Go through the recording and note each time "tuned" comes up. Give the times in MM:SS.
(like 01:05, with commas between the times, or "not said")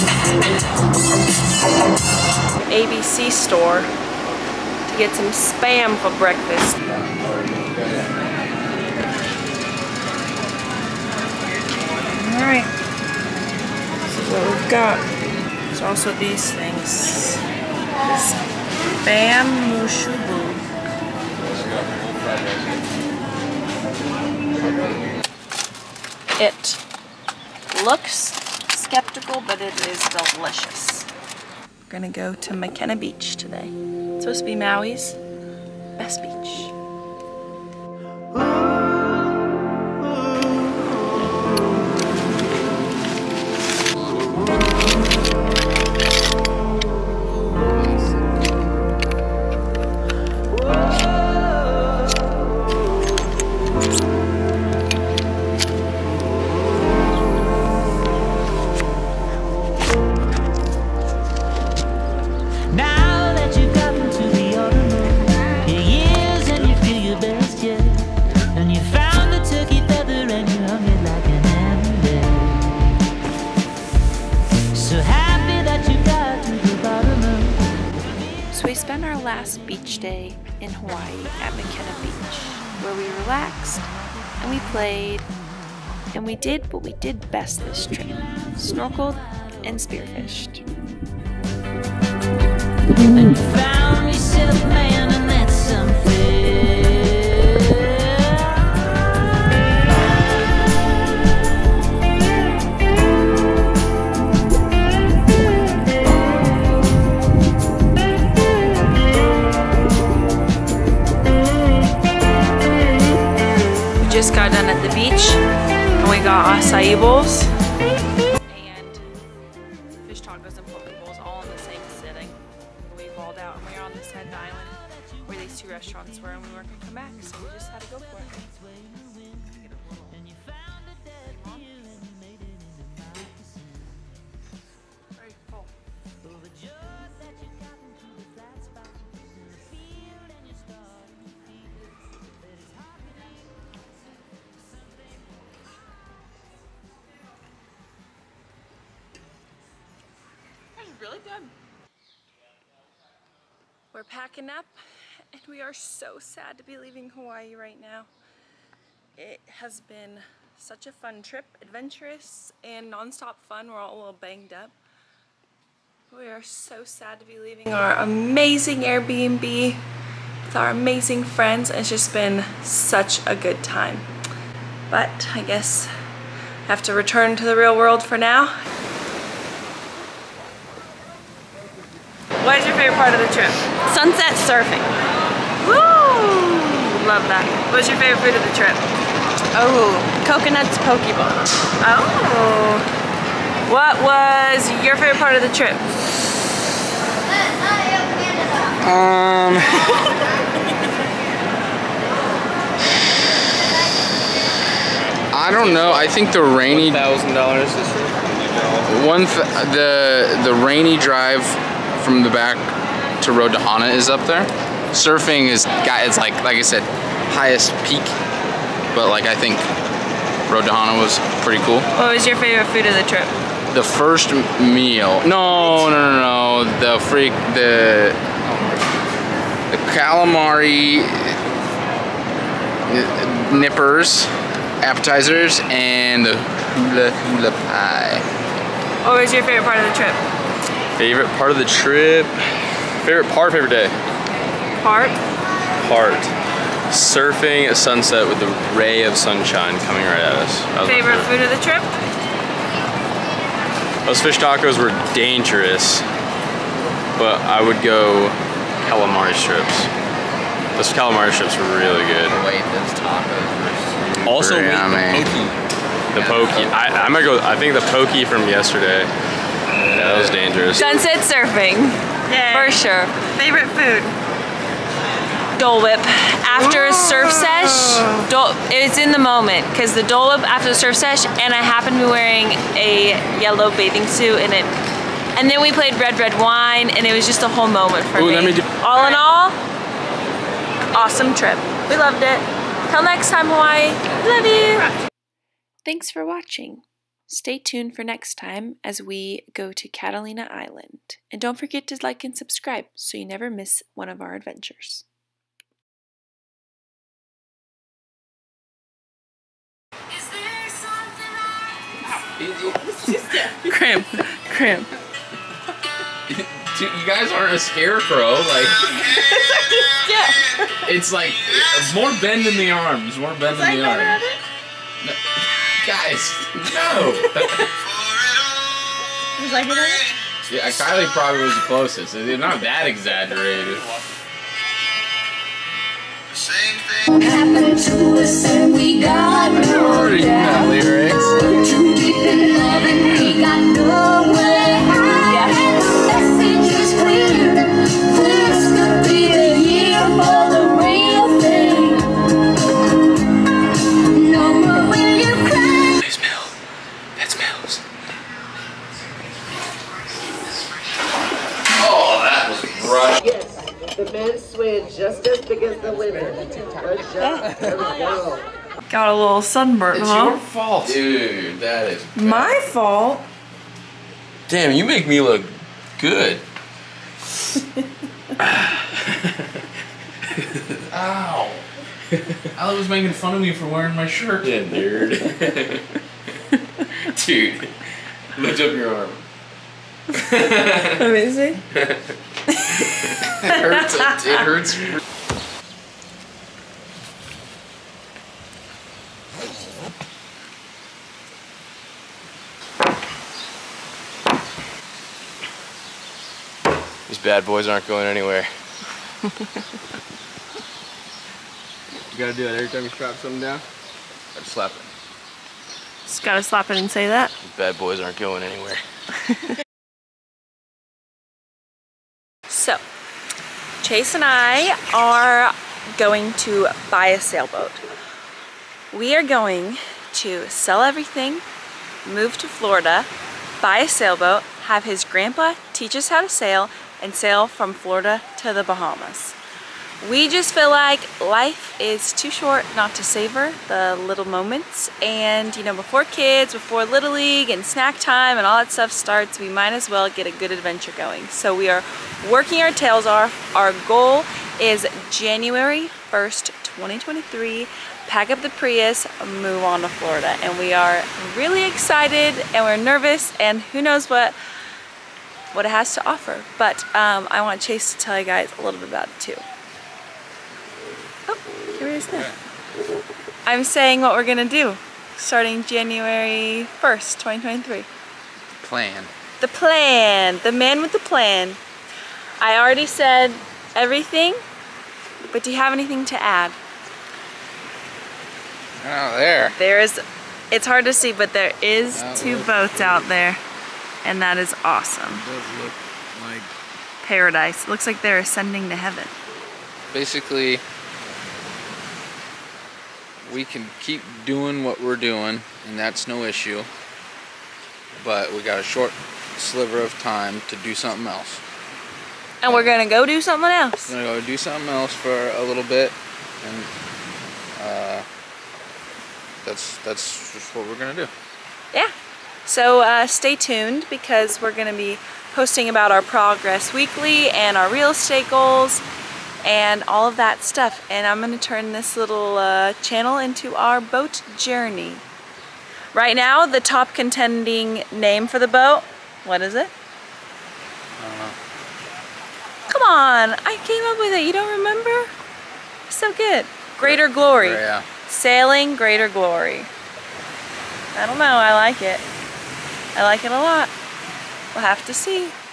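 04:57, 08:43.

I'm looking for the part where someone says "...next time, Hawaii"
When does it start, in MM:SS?
04:53.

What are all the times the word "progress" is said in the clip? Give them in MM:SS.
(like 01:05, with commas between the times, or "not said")
08:46.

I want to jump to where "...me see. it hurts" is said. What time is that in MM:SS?
06:31.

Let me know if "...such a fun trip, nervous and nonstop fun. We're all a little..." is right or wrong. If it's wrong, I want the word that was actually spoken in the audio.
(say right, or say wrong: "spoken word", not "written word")
wrong: "adventurous", not "nervous".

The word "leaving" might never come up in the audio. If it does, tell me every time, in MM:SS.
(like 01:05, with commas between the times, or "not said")
02:36, 02:47.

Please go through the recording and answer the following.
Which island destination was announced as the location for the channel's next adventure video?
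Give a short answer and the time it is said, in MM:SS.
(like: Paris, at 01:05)
Catalina Island, at 04:59.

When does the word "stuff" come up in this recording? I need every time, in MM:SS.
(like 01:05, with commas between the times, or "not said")
07:28, 08:50.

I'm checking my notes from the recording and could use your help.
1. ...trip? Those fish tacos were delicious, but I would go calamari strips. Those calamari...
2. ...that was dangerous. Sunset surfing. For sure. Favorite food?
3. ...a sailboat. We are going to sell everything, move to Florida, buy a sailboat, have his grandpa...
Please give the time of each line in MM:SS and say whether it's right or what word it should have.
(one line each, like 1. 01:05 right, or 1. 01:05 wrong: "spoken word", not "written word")
1. 04:11 wrong: "dangerous", not "delicious"
2. 04:30 right
3. 07:07 right.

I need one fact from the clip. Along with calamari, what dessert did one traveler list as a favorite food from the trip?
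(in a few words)
hula hula pie.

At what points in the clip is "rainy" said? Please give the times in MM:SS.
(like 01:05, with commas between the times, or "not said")
03:26, 03:30.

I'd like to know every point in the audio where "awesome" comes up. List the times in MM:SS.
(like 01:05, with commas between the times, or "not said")
04:50, 08:14.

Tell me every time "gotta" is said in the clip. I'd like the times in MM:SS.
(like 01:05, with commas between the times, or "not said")
06:52, 06:56.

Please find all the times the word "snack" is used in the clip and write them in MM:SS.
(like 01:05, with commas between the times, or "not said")
07:27.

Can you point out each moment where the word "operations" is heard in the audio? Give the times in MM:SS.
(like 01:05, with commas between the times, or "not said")
not said.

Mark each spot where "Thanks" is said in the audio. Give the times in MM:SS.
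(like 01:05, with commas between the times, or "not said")
04:55.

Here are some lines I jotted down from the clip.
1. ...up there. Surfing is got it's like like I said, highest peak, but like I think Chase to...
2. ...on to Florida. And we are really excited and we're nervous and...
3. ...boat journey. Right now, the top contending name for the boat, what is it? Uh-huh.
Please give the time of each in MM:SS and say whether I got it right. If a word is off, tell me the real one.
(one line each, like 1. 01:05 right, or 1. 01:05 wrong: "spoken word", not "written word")
1. 03:34 wrong: "Road", not "Chase"
2. 07:39 right
3. 08:53 right.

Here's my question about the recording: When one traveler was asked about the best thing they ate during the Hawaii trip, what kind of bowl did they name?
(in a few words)
coconuts poke bowl.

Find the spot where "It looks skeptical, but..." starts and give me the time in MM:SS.
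00:26.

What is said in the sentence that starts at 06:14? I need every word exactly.
Damn, you make me look good.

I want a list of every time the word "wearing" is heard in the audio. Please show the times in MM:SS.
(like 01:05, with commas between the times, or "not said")
04:42, 06:23.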